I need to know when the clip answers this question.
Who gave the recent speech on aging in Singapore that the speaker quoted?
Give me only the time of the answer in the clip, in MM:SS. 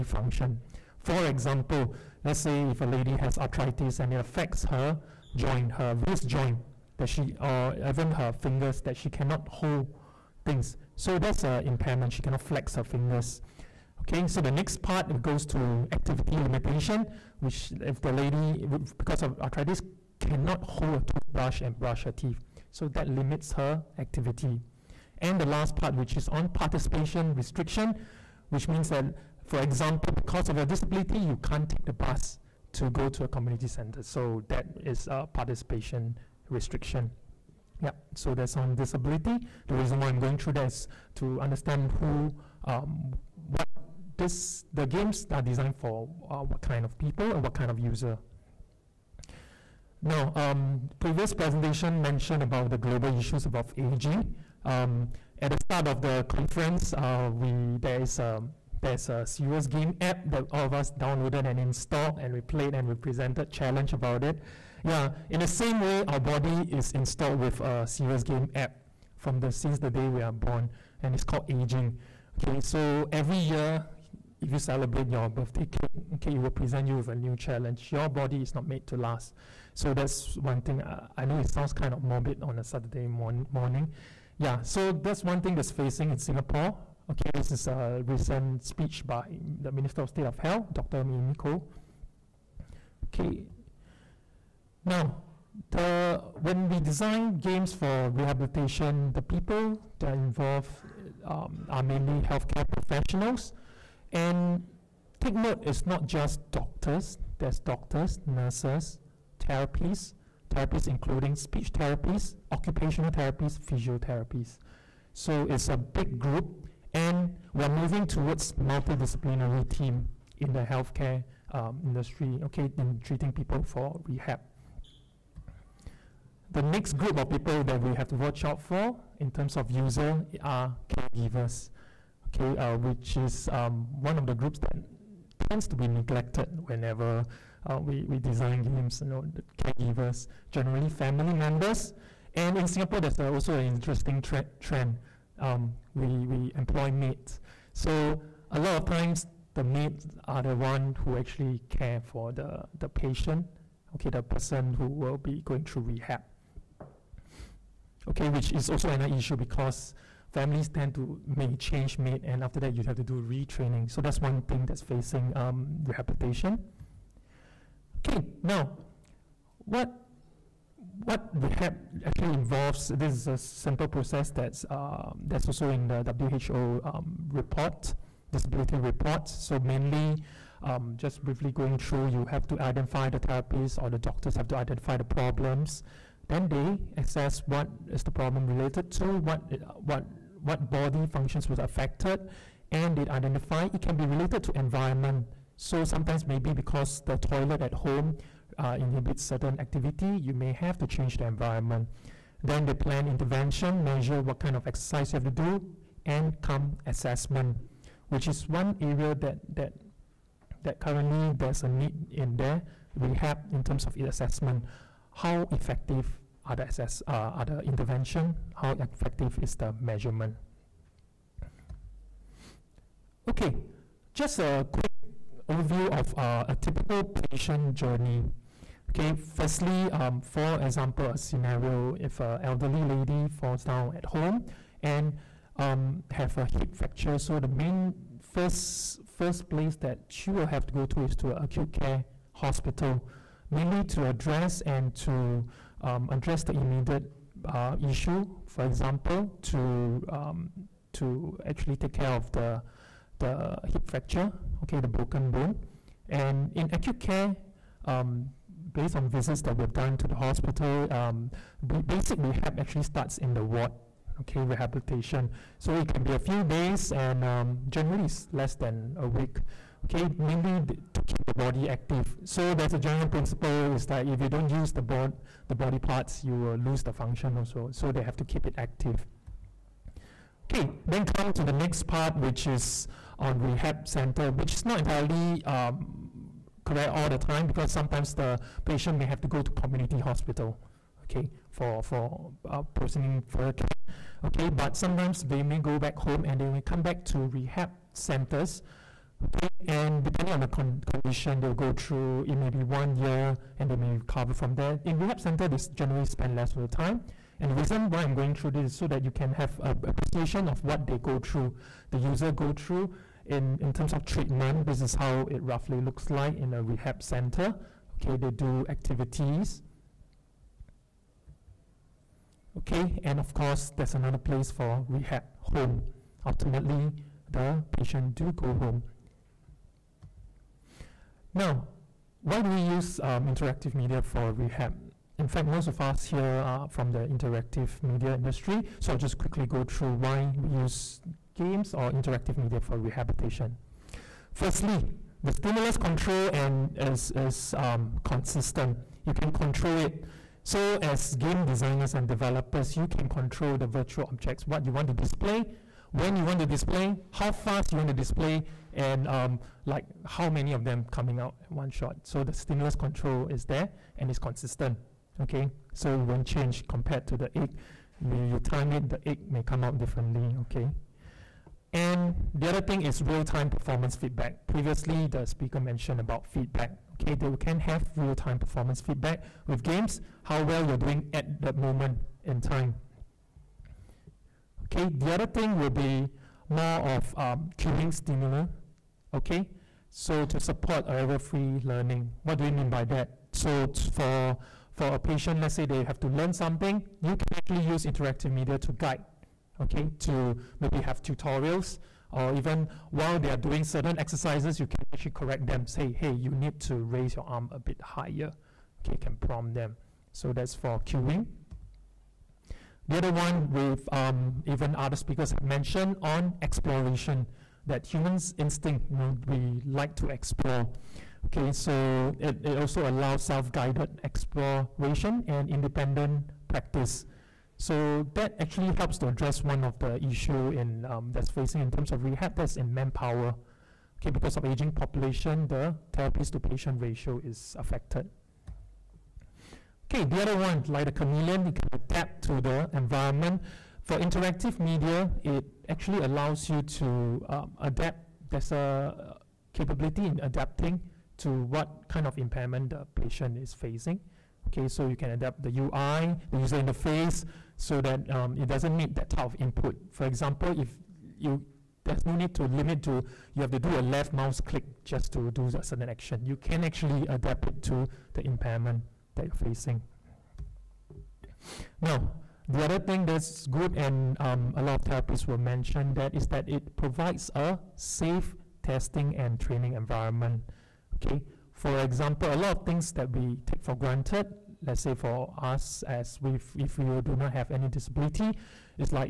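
01:30.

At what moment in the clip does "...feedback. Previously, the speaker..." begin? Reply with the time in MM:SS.
06:13.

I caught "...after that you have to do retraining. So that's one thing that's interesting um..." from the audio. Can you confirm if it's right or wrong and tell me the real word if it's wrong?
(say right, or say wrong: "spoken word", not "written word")
wrong: "facing", not "interesting".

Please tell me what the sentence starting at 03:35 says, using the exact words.
How effective other access, uh, other intervention?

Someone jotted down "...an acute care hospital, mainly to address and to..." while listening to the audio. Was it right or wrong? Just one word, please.
right.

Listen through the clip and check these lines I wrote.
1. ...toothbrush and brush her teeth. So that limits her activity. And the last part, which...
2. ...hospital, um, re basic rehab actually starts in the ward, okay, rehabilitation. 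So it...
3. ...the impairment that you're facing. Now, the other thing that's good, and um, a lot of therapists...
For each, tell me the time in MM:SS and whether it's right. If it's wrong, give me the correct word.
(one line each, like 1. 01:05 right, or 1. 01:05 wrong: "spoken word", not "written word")
1. 00:21 right
2. 04:20 right
3. 07:48 right.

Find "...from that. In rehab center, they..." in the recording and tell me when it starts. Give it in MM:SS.
05:04.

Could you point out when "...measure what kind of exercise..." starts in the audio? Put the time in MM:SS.
03:23.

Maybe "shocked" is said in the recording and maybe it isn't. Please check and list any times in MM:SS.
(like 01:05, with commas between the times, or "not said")
not said.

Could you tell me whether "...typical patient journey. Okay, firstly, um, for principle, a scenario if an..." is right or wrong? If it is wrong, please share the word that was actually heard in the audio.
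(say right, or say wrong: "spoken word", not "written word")
wrong: "example", not "principle".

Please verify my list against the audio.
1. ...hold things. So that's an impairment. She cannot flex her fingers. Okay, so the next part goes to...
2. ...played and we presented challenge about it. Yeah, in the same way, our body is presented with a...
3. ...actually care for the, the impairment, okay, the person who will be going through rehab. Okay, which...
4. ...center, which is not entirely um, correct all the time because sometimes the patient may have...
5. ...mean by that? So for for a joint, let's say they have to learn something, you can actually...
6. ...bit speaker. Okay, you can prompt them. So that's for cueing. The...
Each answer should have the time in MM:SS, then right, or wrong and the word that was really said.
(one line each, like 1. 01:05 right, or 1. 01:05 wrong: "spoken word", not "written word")
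1. 00:09 right
2. 01:02 wrong: "installed", not "presented"
3. 02:31 wrong: "patient", not "impairment"
4. 04:43 right
5. 06:32 wrong: "patient", not "joint"
6. 06:47 wrong: "higher", not "speaker".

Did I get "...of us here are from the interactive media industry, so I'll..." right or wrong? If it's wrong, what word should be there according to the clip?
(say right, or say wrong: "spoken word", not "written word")
right.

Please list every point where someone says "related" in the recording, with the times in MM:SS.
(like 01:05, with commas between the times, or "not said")
03:08, 03:14.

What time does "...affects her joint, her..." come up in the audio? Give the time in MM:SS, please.
00:04.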